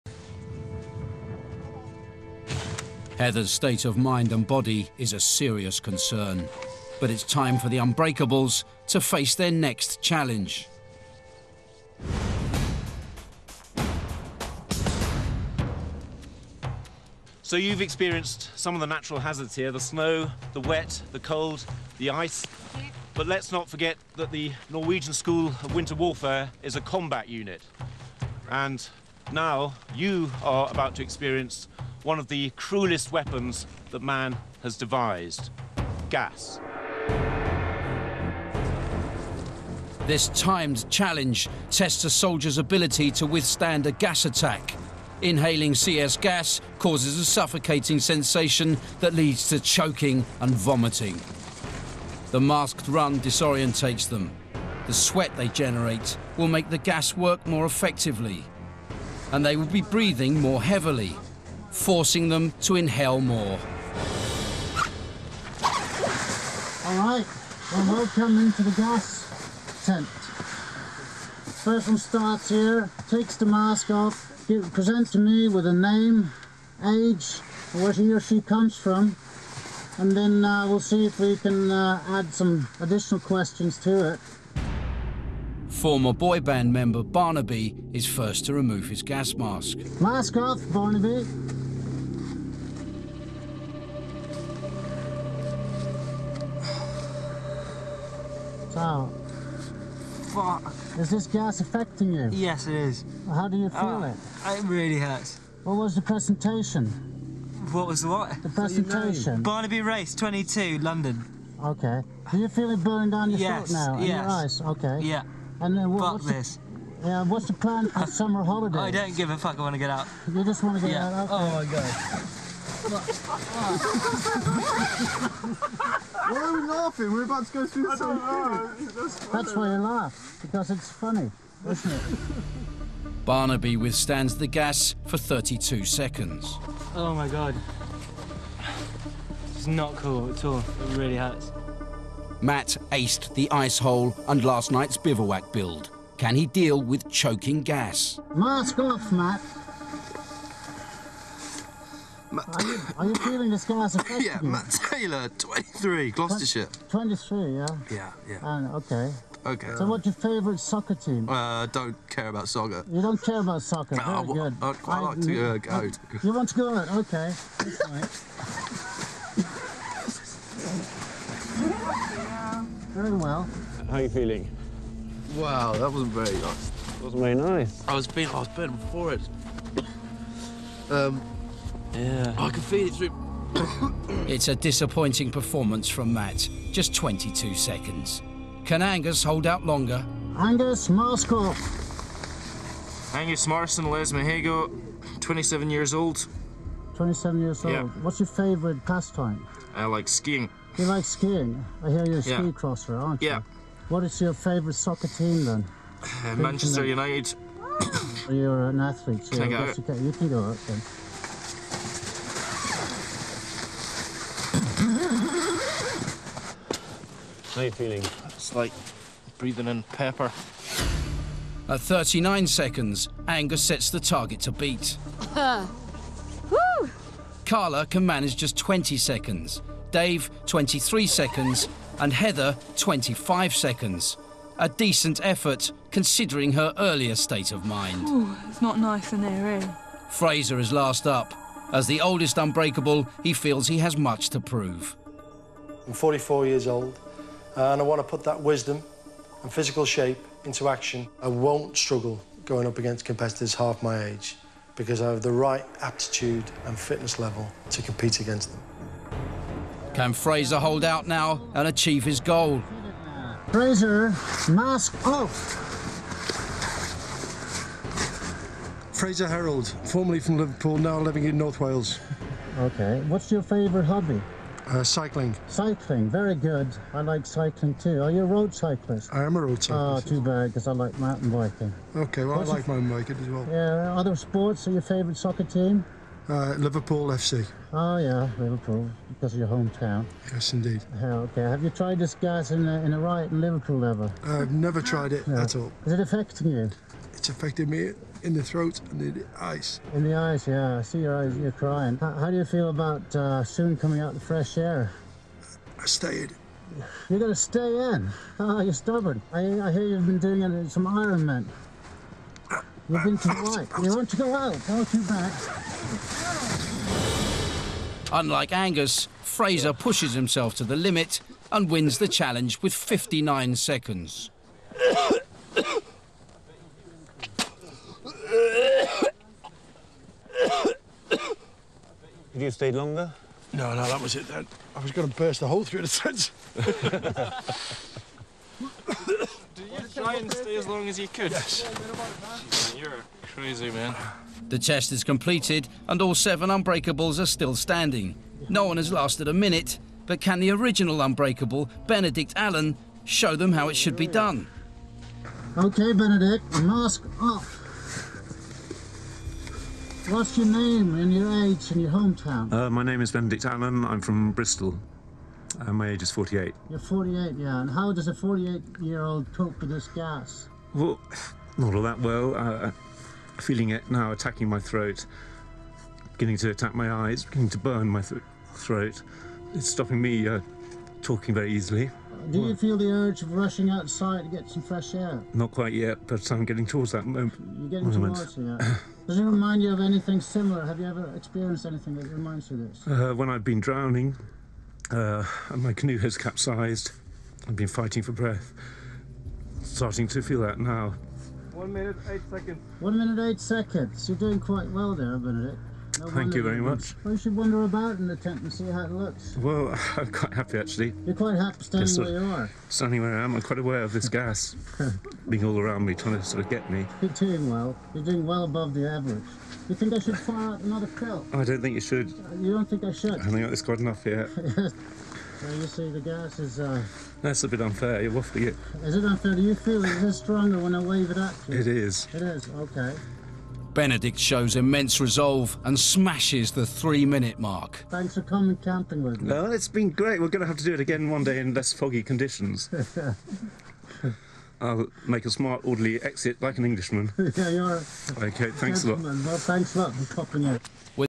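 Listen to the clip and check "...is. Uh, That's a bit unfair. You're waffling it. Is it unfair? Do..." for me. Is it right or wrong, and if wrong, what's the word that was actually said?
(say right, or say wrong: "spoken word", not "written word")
right.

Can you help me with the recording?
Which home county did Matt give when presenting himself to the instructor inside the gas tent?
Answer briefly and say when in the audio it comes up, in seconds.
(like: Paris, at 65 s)
Gloucestershire, at 156 s.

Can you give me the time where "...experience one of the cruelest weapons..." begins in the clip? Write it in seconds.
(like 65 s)
31 s.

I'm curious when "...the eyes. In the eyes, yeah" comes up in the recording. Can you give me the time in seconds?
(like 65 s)
298 s.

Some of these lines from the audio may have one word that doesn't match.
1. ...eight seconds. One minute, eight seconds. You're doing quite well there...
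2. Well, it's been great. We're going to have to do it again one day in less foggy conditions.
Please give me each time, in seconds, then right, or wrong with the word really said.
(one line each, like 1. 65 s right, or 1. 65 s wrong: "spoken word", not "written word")
1. 402 s right
2. 439 s right.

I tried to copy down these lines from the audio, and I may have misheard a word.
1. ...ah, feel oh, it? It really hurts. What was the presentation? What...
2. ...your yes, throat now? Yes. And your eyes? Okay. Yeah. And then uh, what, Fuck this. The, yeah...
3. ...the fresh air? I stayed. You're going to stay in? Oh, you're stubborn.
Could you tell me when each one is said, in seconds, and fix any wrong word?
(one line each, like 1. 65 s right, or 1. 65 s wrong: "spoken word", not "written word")
1. 103 s right
2. 113 s right
3. 304 s right.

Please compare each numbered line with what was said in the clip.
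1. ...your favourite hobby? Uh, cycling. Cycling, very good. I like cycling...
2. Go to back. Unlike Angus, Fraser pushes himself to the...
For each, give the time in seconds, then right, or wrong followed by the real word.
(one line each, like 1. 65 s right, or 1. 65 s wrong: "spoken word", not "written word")
1. 273 s right
2. 314 s right.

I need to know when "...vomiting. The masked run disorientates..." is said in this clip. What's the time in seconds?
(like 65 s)
50 s.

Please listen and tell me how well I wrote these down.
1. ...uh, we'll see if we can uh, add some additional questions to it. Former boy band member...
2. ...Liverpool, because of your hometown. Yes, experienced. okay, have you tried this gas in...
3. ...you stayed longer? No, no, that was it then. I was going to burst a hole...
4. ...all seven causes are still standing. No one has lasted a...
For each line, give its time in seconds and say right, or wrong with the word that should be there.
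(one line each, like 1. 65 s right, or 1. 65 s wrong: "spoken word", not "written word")
1. 80 s right
2. 288 s wrong: "indeed", not "experienced"
3. 332 s right
4. 346 s wrong: "unbreakables", not "causes".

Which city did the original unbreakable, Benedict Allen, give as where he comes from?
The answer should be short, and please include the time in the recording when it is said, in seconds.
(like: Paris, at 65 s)
Bristol, at 364 s.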